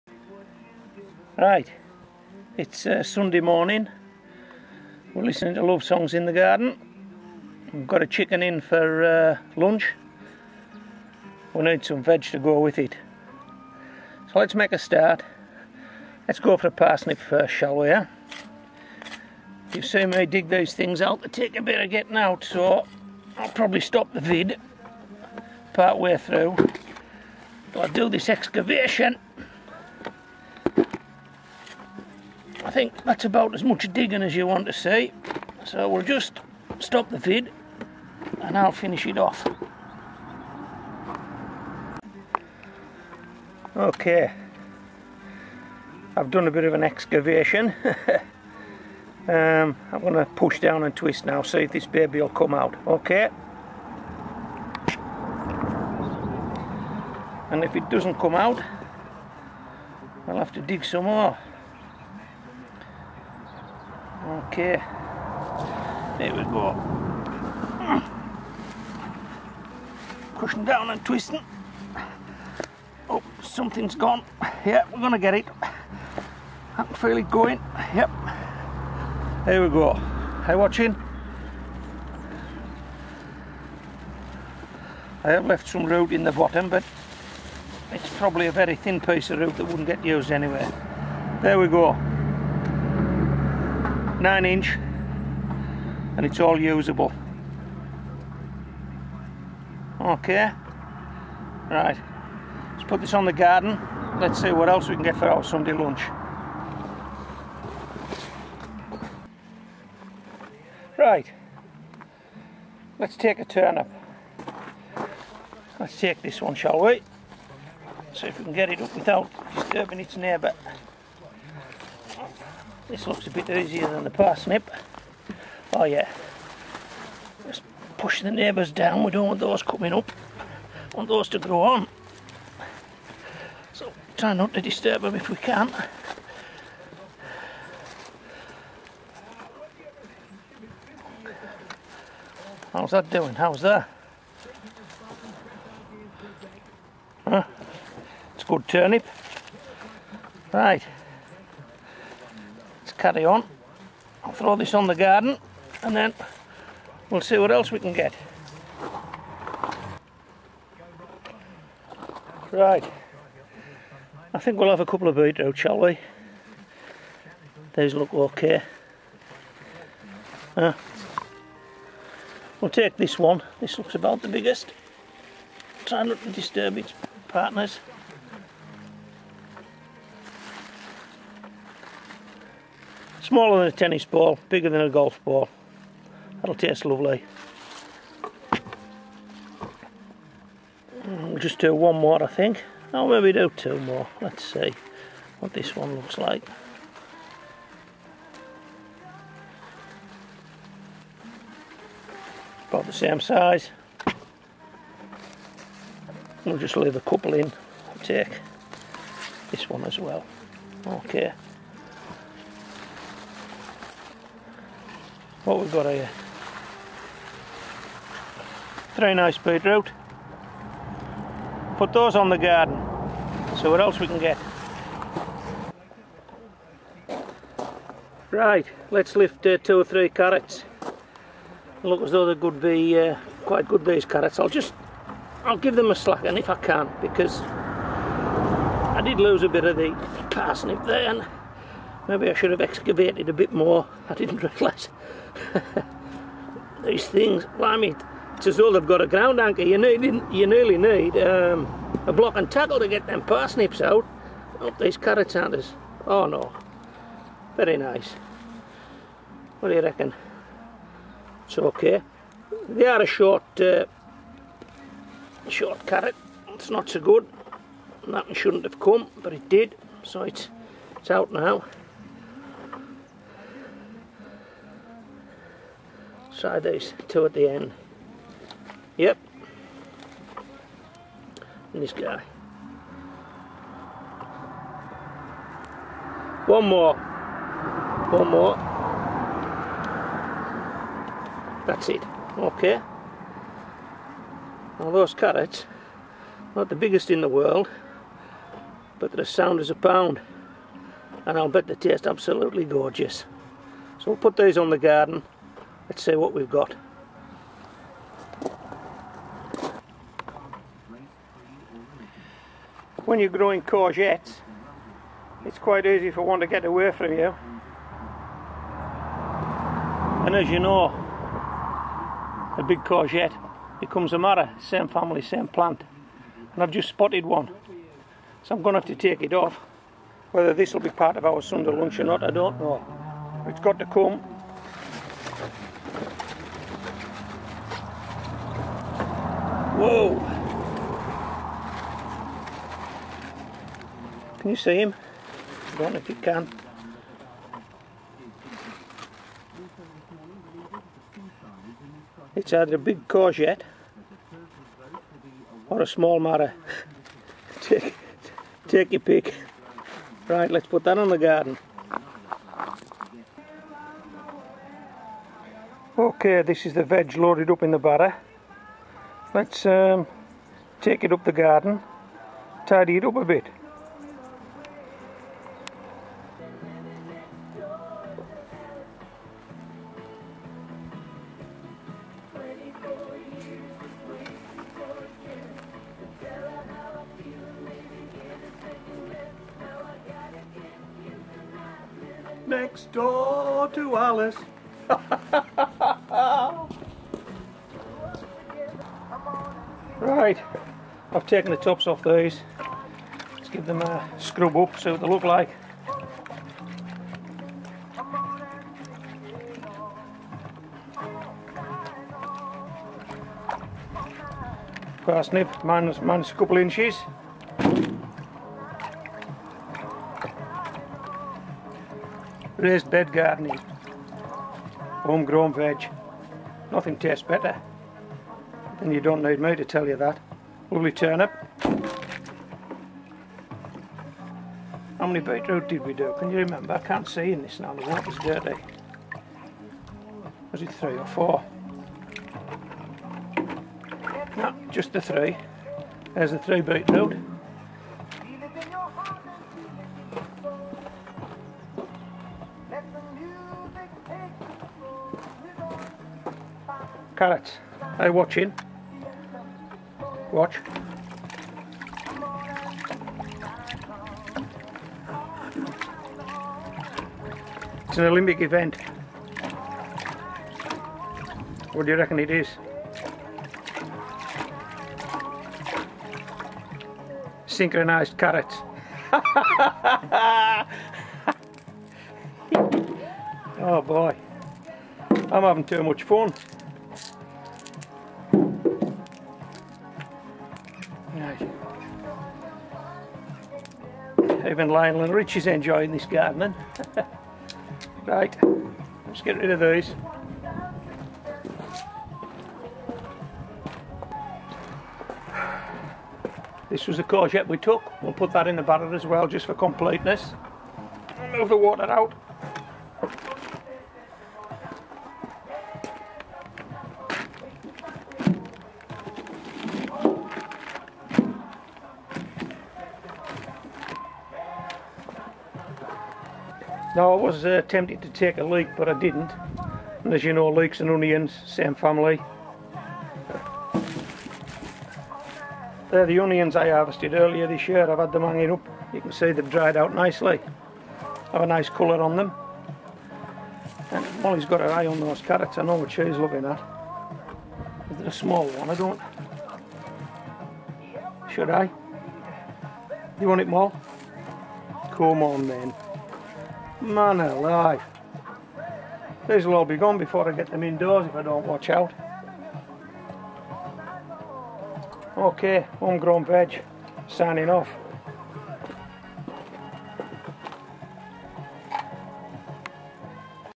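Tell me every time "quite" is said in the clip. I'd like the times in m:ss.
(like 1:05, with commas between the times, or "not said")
3:53, 5:15.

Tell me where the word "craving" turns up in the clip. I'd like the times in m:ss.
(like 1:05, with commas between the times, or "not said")
not said.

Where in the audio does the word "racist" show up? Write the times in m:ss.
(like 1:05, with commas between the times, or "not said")
not said.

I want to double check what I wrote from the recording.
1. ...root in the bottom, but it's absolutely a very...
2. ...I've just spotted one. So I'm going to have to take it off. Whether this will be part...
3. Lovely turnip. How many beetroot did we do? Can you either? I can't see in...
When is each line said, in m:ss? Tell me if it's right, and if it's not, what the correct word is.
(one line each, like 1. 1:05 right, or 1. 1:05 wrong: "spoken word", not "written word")
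1. 1:25 wrong: "probably", not "absolutely"
2. 5:26 right
3. 7:10 wrong: "remember", not "either".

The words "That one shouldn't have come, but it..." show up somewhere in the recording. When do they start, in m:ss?
4:28.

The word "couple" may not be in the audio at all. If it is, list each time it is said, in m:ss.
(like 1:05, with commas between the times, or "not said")
2:44, 3:27, 6:56.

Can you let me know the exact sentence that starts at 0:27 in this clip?
But I'll do this excavation I think that's about as much digging as you want to see.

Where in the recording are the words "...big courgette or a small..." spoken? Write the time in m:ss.
5:52.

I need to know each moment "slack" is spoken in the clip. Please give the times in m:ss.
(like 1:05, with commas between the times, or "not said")
3:55.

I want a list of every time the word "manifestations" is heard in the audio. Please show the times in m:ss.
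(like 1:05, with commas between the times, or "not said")
not said.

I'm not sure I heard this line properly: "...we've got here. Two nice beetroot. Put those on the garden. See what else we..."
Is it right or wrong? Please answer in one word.
wrong.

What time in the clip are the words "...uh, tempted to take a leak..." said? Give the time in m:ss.
8:47.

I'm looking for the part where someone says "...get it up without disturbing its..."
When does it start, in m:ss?
1:58.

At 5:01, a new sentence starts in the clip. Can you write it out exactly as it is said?
And I'll bet they taste absolutely gorgeous.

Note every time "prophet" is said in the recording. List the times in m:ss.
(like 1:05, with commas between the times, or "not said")
not said.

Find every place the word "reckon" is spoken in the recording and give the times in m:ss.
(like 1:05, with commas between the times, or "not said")
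4:19, 7:51.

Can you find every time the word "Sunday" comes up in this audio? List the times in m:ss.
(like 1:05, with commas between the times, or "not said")
0:03, 1:45, 5:31.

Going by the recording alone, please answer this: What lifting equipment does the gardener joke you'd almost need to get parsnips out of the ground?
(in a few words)
A block and tackle.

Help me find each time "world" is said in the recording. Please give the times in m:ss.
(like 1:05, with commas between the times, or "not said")
4:57.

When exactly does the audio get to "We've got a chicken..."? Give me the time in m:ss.
0:07.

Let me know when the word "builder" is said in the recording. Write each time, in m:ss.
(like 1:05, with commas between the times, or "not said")
not said.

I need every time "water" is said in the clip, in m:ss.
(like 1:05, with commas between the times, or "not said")
7:17, 8:31.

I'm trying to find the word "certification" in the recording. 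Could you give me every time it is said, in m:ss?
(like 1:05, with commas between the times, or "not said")
not said.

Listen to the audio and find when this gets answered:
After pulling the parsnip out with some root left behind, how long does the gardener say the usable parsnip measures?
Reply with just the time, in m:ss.
1:34.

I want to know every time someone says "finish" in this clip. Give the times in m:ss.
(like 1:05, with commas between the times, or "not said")
0:38.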